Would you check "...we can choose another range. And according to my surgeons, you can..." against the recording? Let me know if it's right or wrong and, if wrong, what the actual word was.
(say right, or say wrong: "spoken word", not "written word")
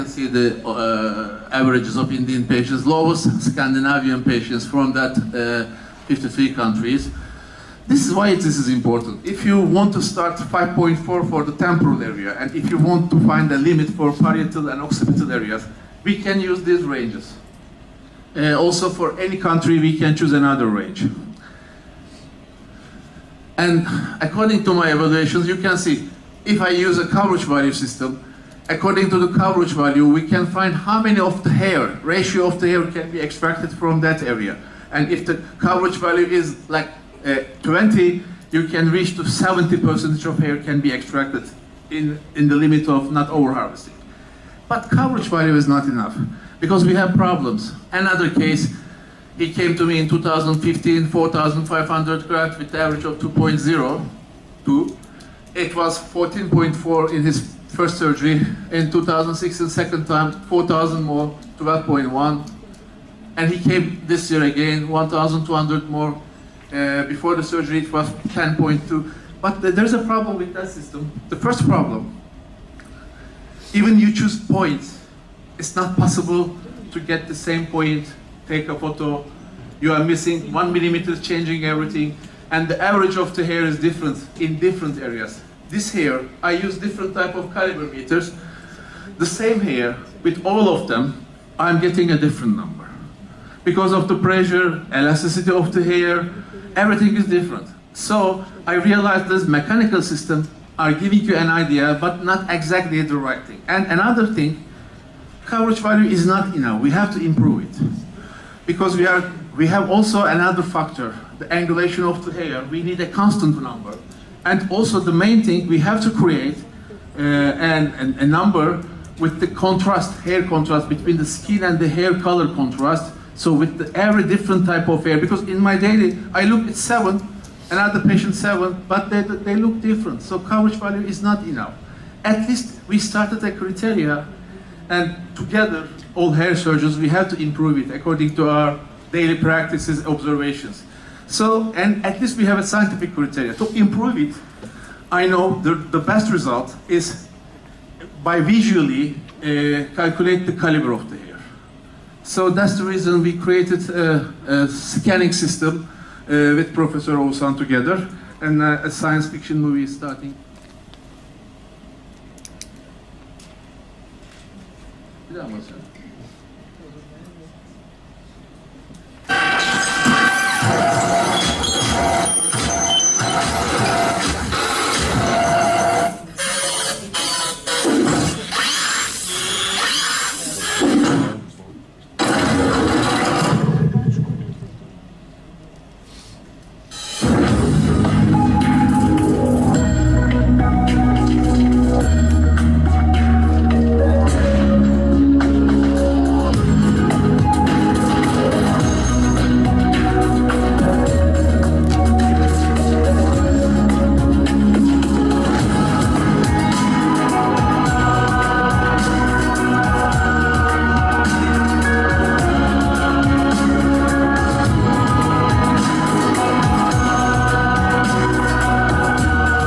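wrong: "evaluations", not "surgeons".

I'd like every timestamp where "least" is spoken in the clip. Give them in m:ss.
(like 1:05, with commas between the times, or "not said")
2:12, 2:22.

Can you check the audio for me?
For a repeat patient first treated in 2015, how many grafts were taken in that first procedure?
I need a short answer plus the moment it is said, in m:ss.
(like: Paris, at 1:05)
4,500, at 0:51.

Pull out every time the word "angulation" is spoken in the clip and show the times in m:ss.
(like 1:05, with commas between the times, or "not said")
1:51.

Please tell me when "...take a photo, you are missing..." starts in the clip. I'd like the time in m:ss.
1:18.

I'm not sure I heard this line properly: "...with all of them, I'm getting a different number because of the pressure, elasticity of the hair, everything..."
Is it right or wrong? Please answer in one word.
right.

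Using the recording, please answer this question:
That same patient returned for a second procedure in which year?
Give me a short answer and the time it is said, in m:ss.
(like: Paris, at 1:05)
2016, at 0:58.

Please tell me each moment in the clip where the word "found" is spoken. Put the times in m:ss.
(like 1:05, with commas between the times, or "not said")
not said.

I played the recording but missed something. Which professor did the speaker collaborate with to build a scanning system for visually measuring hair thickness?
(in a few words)
Professor Oğuzhan.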